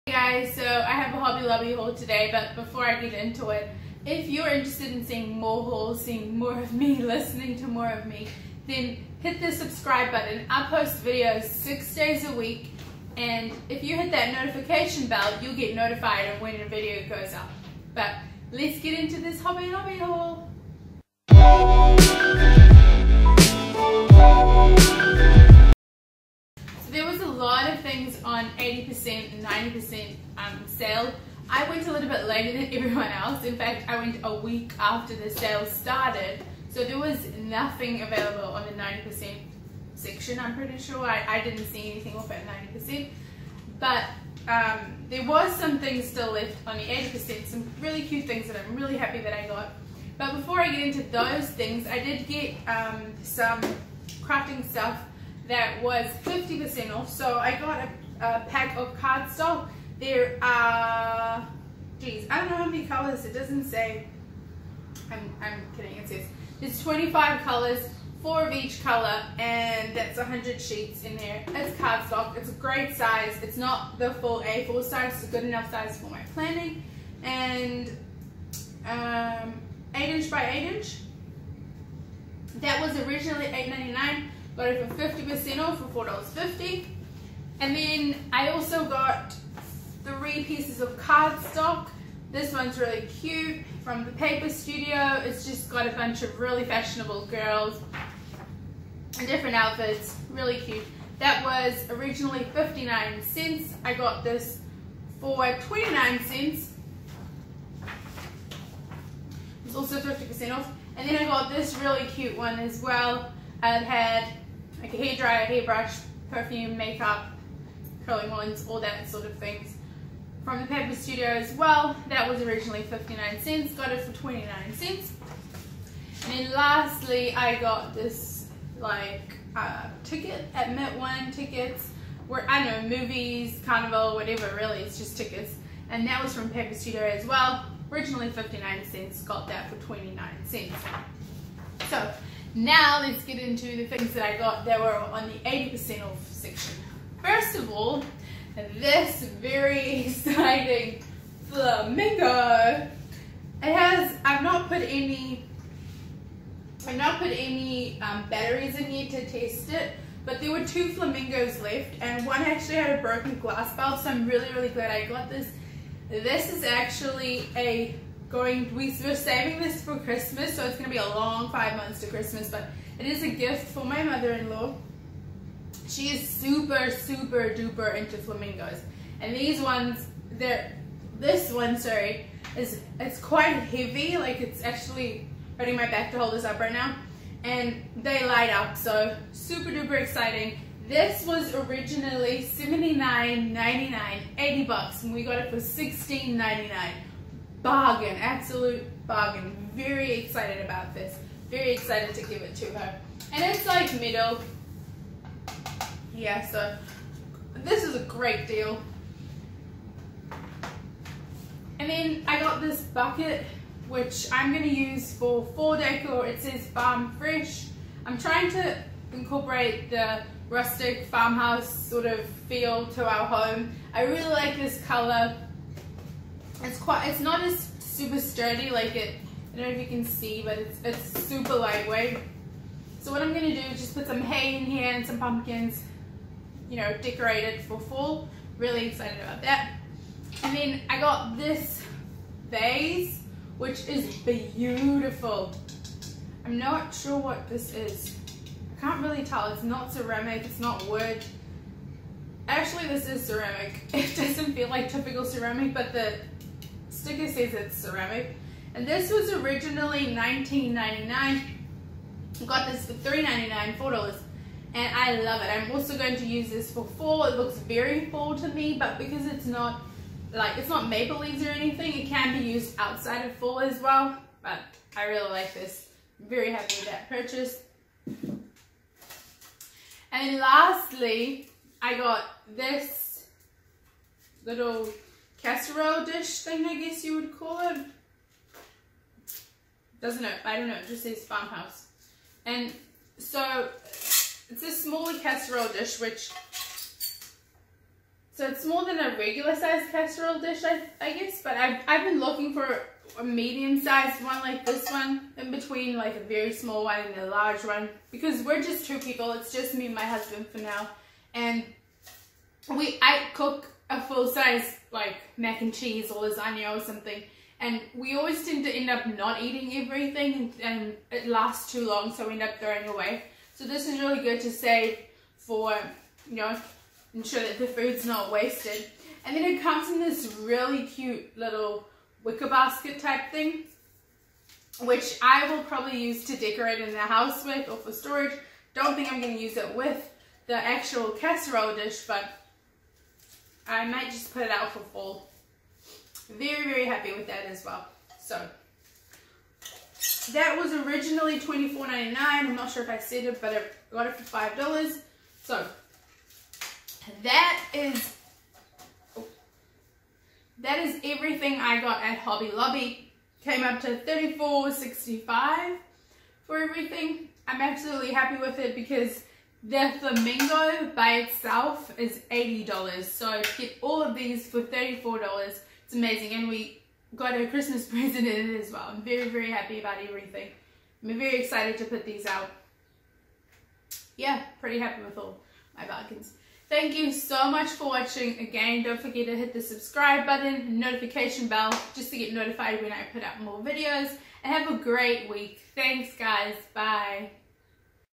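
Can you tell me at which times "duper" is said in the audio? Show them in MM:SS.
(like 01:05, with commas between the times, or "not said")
02:57, 03:09.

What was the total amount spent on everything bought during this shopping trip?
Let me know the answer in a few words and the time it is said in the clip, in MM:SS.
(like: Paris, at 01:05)
$34.65, at 06:03.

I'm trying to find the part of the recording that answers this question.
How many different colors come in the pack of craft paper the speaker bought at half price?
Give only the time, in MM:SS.
01:06.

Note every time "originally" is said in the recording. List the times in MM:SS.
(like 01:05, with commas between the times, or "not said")
01:22, 01:41, 02:02, 02:17, 03:11, 04:19, 05:50.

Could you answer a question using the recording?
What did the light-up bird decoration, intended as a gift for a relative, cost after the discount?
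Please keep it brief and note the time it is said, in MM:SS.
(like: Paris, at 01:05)
$16.99, at 03:15.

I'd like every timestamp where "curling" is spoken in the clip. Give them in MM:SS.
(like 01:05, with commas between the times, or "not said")
01:58.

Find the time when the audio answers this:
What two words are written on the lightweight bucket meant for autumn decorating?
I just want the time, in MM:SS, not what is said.
03:36.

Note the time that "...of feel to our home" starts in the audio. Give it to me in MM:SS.
03:42.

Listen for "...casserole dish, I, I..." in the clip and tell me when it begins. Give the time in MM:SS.
04:59.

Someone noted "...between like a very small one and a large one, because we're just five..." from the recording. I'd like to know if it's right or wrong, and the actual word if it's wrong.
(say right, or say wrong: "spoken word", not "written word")
wrong: "two", not "five".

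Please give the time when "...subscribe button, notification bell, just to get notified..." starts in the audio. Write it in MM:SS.
06:29.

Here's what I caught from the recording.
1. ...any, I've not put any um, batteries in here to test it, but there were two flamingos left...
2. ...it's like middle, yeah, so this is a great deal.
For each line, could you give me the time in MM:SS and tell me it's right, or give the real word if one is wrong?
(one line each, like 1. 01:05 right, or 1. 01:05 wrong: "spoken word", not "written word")
1. 02:34 right
2. 03:23 right.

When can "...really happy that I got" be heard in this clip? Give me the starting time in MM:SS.
00:48.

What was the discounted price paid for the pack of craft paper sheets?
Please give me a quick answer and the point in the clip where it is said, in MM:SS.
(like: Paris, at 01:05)
$4.50, at 01:26.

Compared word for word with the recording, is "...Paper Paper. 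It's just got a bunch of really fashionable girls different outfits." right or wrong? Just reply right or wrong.
wrong.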